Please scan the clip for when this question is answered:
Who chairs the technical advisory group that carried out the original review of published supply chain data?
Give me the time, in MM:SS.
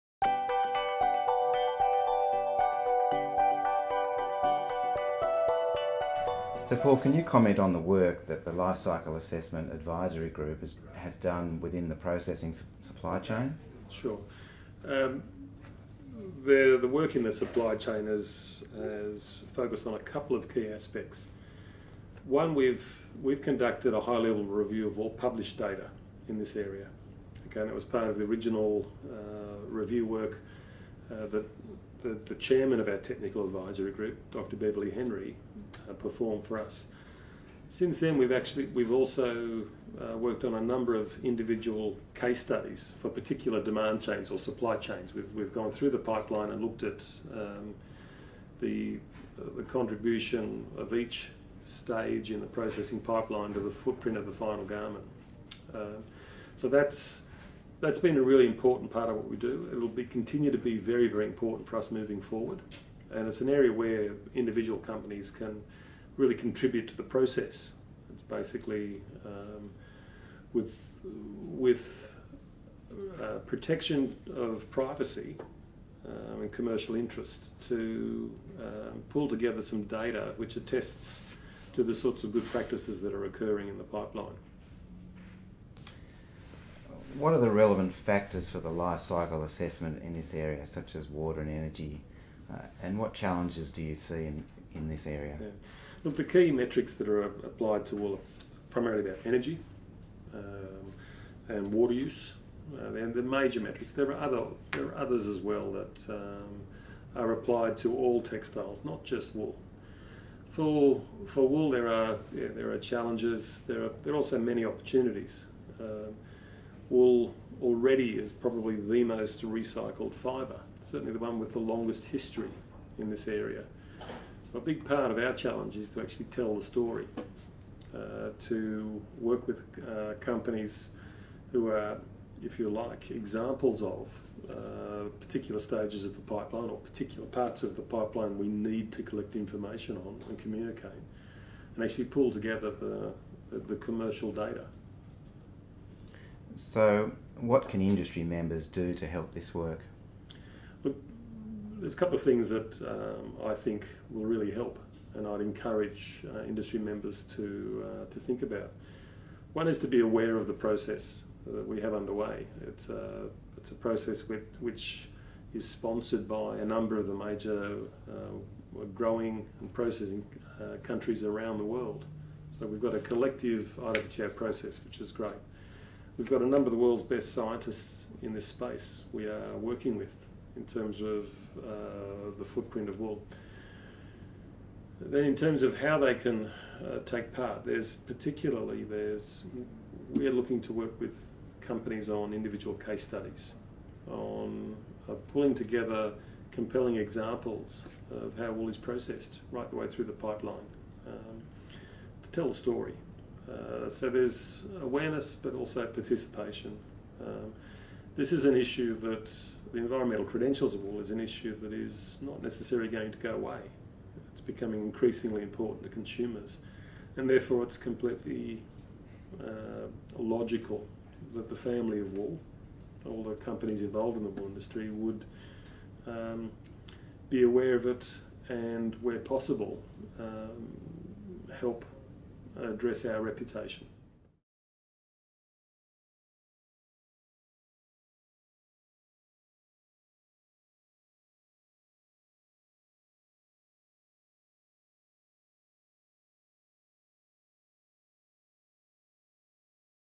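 00:34.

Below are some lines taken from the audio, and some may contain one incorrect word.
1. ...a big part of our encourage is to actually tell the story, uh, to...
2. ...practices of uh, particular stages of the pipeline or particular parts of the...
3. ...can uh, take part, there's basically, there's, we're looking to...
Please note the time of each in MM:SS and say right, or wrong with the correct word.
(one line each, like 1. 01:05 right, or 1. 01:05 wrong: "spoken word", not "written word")
1. 02:04 wrong: "challenge", not "encourage"
2. 02:13 wrong: "examples", not "practices"
3. 03:06 wrong: "particularly", not "basically".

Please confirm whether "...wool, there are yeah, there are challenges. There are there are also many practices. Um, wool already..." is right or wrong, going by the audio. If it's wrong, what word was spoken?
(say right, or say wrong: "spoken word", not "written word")
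wrong: "opportunities", not "practices".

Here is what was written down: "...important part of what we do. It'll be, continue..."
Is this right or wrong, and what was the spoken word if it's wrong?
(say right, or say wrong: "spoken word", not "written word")
right.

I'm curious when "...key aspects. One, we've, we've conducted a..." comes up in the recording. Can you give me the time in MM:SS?
00:20.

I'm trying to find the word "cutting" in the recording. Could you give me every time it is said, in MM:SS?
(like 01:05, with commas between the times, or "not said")
not said.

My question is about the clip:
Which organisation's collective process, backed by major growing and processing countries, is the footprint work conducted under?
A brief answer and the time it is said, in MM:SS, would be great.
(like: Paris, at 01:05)
IWTO, at 02:53.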